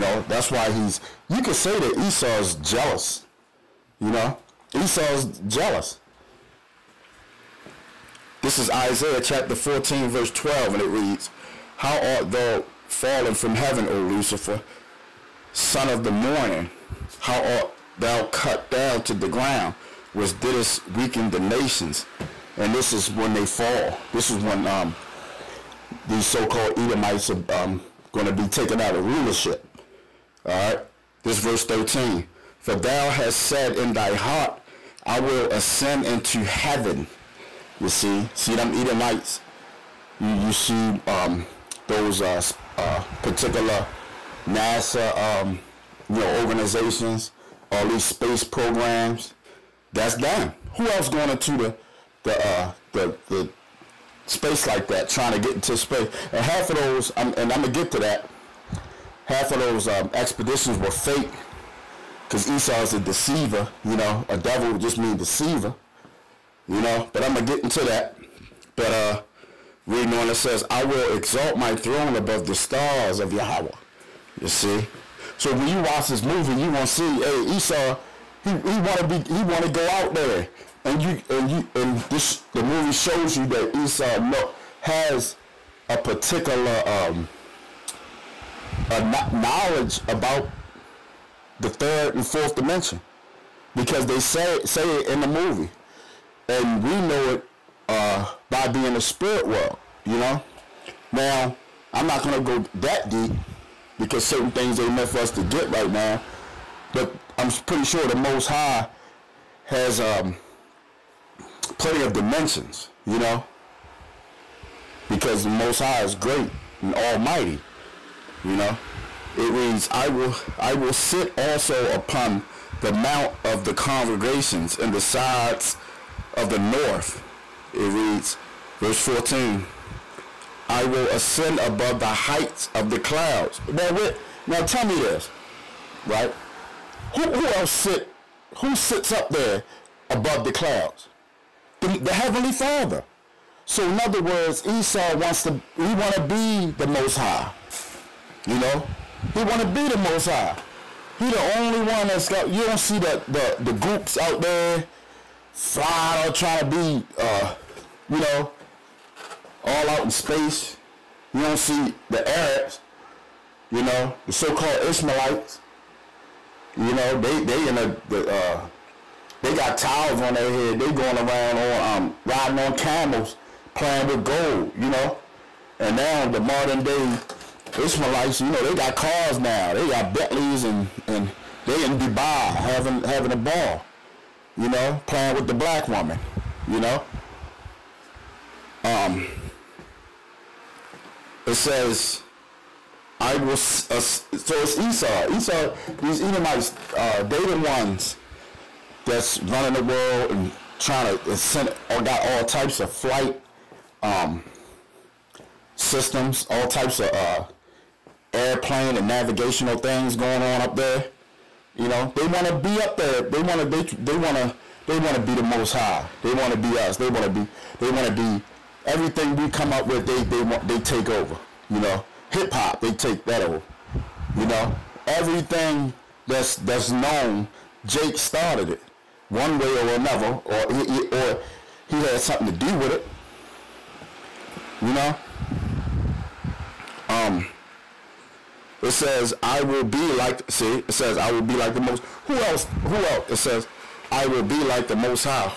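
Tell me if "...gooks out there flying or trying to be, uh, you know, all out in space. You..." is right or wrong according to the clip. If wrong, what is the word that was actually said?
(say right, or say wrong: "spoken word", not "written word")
right.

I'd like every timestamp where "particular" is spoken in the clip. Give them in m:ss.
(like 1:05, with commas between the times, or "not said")
0:43, 1:25.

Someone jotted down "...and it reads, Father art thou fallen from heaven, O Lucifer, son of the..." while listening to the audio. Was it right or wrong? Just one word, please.
wrong.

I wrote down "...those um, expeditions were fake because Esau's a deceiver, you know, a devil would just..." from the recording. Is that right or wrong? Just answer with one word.
right.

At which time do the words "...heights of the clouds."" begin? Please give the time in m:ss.
2:12.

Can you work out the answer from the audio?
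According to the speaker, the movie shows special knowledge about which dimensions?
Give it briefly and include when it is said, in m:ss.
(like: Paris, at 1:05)
Third and fourth, at 1:31.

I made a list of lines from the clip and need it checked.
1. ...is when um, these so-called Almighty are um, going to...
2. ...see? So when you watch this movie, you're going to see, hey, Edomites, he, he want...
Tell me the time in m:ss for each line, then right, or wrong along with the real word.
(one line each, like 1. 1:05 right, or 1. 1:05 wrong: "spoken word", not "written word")
1. 0:24 wrong: "Edomites", not "Almighty"
2. 1:14 wrong: "Esau", not "Edomites".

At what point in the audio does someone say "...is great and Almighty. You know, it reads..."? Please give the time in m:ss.
1:56.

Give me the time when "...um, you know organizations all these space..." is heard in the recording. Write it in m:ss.
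0:45.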